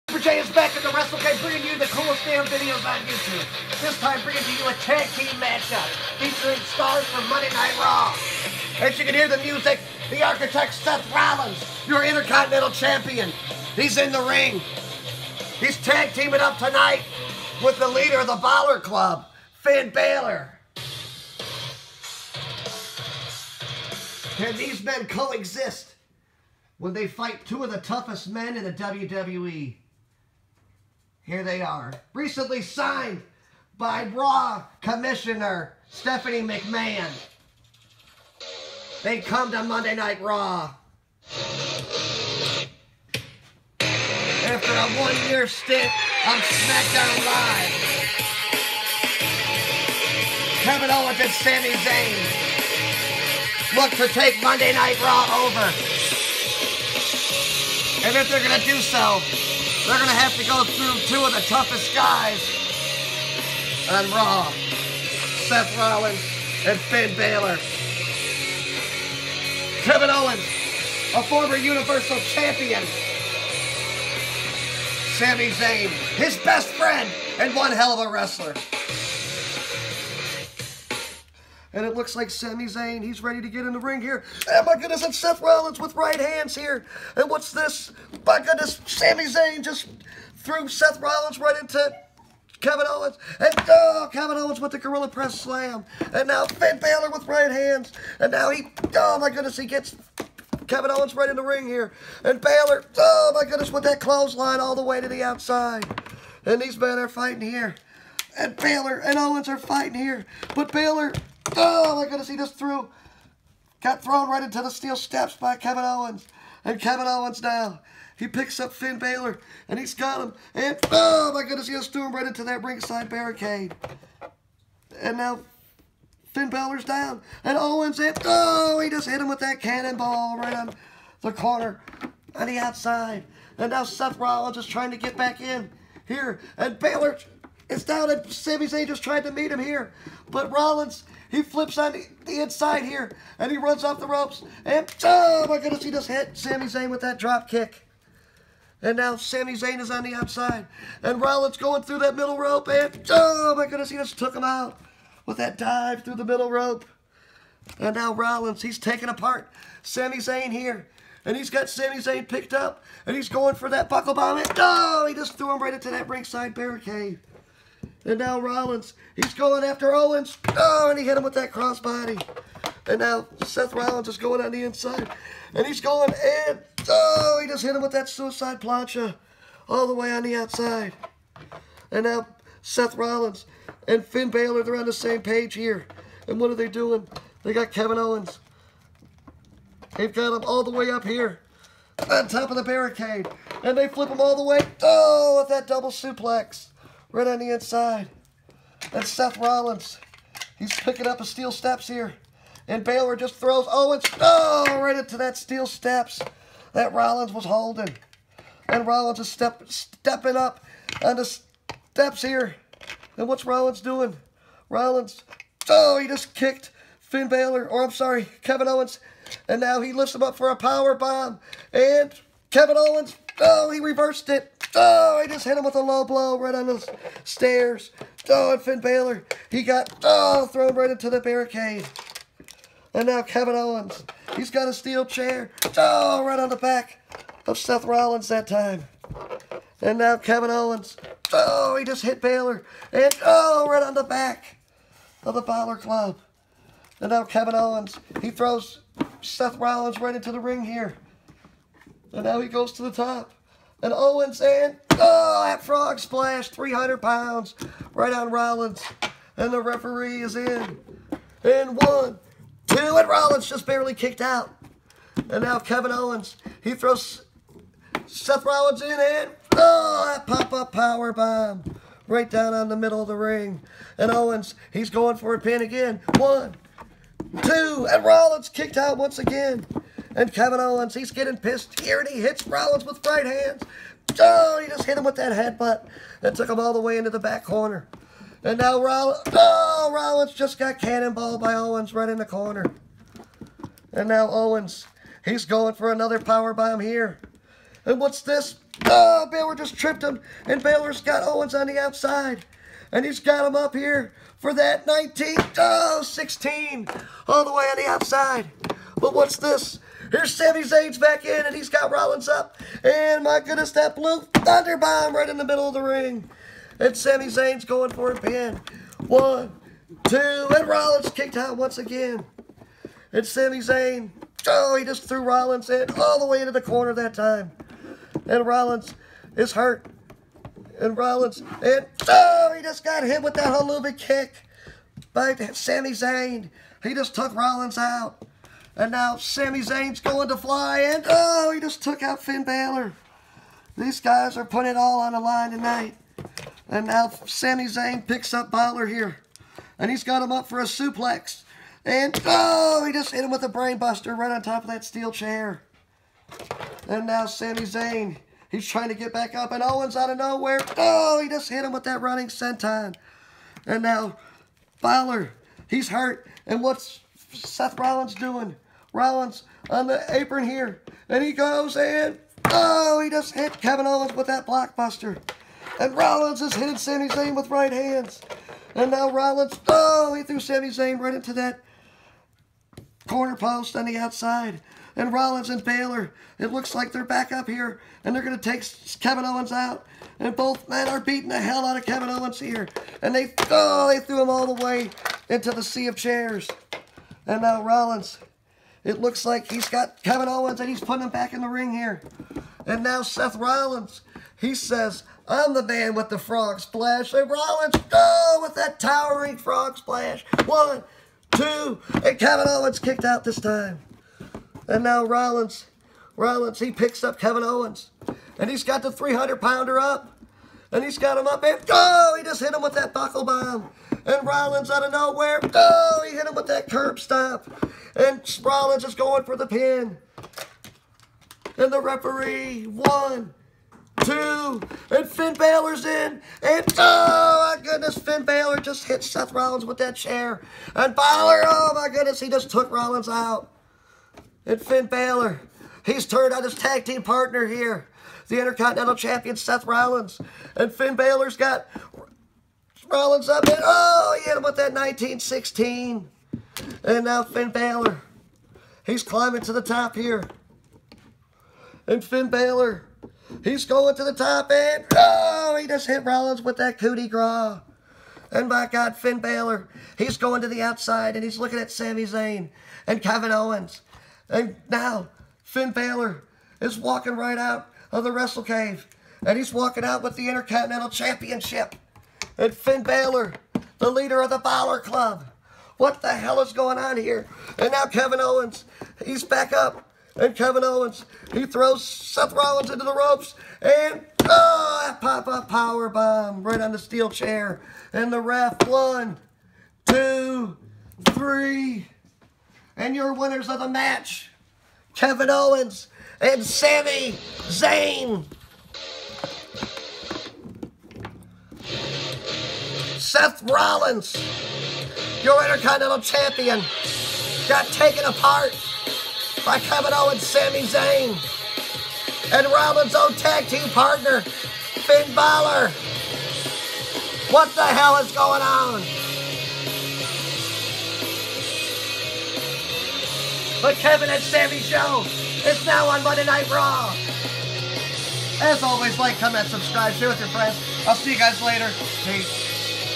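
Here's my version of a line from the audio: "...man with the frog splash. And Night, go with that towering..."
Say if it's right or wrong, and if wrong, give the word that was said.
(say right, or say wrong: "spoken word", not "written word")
wrong: "Rollins", not "Night".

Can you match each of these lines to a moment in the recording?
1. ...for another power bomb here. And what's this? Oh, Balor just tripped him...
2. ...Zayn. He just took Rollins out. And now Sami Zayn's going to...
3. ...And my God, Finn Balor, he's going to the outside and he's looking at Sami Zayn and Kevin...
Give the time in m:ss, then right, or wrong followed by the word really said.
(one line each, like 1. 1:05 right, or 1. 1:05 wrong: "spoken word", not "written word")
1. 4:55 right
2. 5:35 right
3. 7:48 right.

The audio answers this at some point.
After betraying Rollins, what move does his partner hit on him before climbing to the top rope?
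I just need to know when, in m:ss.
7:34.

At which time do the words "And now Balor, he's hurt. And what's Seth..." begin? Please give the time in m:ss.
6:03.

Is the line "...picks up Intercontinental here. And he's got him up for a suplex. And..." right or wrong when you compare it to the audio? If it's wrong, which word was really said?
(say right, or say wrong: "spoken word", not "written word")
wrong: "Balor", not "Intercontinental".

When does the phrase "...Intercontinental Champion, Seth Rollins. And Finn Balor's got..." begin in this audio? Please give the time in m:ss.
7:28.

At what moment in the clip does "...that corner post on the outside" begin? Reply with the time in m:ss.
6:21.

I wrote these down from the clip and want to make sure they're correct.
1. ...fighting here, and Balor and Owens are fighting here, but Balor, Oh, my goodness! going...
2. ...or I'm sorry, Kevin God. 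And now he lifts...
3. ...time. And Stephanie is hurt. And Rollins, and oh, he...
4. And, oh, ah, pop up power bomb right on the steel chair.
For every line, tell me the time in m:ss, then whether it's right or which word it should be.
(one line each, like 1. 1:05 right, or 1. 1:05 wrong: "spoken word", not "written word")
1. 1:47 right
2. 3:37 wrong: "Owens", not "God"
3. 5:27 wrong: "Rollins", not "Stephanie"
4. 8:13 right.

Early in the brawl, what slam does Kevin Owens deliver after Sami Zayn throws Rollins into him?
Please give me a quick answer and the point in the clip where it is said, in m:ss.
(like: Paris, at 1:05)
Gorilla Press Slam, at 1:34.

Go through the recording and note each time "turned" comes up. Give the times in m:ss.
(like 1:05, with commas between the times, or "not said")
7:26.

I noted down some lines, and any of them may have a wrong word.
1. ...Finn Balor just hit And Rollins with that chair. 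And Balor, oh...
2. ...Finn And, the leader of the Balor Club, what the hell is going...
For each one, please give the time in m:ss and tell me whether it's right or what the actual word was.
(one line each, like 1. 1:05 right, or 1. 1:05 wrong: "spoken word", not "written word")
1. 7:17 wrong: "Seth", not "And"
2. 8:02 wrong: "Balor", not "And".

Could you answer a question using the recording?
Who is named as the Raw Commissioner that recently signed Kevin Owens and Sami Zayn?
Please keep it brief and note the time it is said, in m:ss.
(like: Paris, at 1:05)
Stephanie McMahon, at 0:35.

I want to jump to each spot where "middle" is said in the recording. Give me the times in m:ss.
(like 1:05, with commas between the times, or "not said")
2:32, 2:36, 4:32, 5:15.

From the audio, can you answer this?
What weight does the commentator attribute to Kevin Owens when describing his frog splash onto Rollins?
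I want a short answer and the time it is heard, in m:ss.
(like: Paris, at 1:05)
300 pounds, at 4:16.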